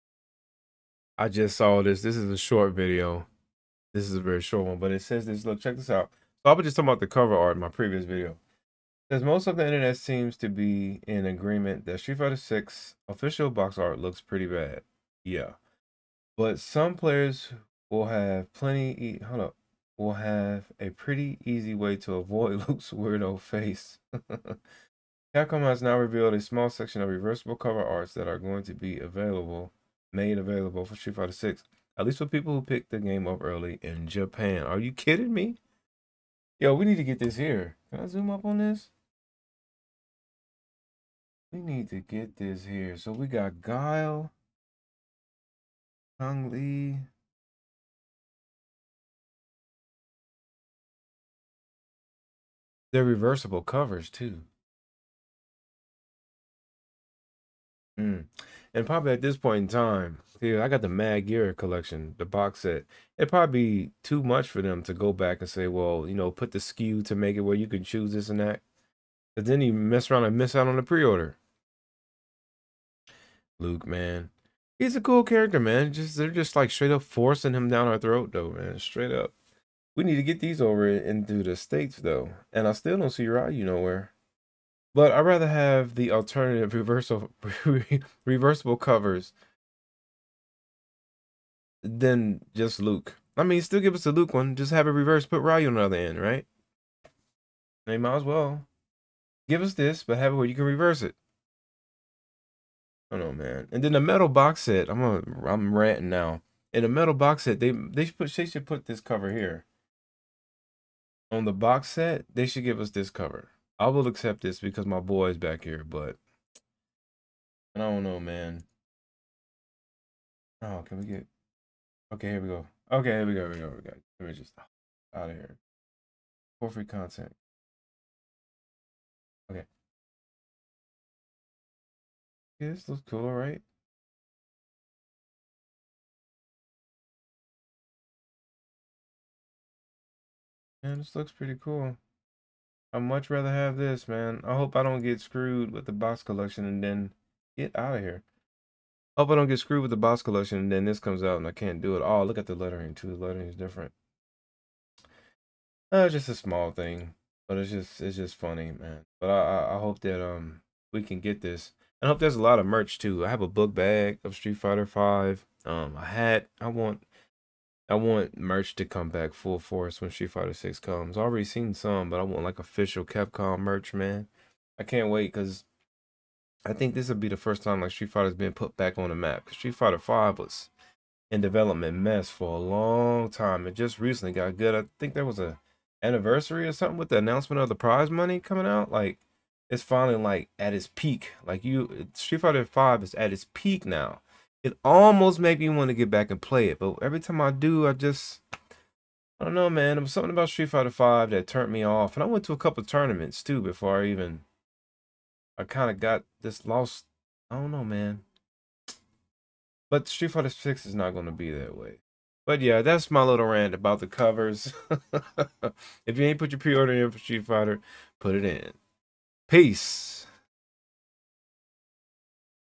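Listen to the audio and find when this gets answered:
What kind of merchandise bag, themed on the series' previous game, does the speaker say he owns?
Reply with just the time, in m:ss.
2:43.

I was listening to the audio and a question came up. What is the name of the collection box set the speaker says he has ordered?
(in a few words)
Mad Gear collection.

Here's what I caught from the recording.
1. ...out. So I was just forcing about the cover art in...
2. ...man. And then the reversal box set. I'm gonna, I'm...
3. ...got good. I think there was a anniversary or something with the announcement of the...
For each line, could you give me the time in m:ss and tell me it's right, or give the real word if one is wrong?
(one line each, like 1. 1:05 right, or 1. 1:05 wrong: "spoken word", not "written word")
1. 0:05 wrong: "talking", not "forcing"
2. 1:43 wrong: "metal", not "reversal"
3. 3:04 right.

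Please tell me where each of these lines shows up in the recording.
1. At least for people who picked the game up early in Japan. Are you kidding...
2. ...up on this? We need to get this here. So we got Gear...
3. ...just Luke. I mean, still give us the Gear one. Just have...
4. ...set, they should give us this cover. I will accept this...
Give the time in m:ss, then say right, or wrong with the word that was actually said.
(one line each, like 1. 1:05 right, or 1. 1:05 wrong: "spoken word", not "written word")
1. 0:31 right
2. 0:38 wrong: "Guile", not "Gear"
3. 1:32 wrong: "Luke", not "Gear"
4. 1:51 right.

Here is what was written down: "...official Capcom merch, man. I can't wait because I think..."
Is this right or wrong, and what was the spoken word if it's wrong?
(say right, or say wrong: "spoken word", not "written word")
right.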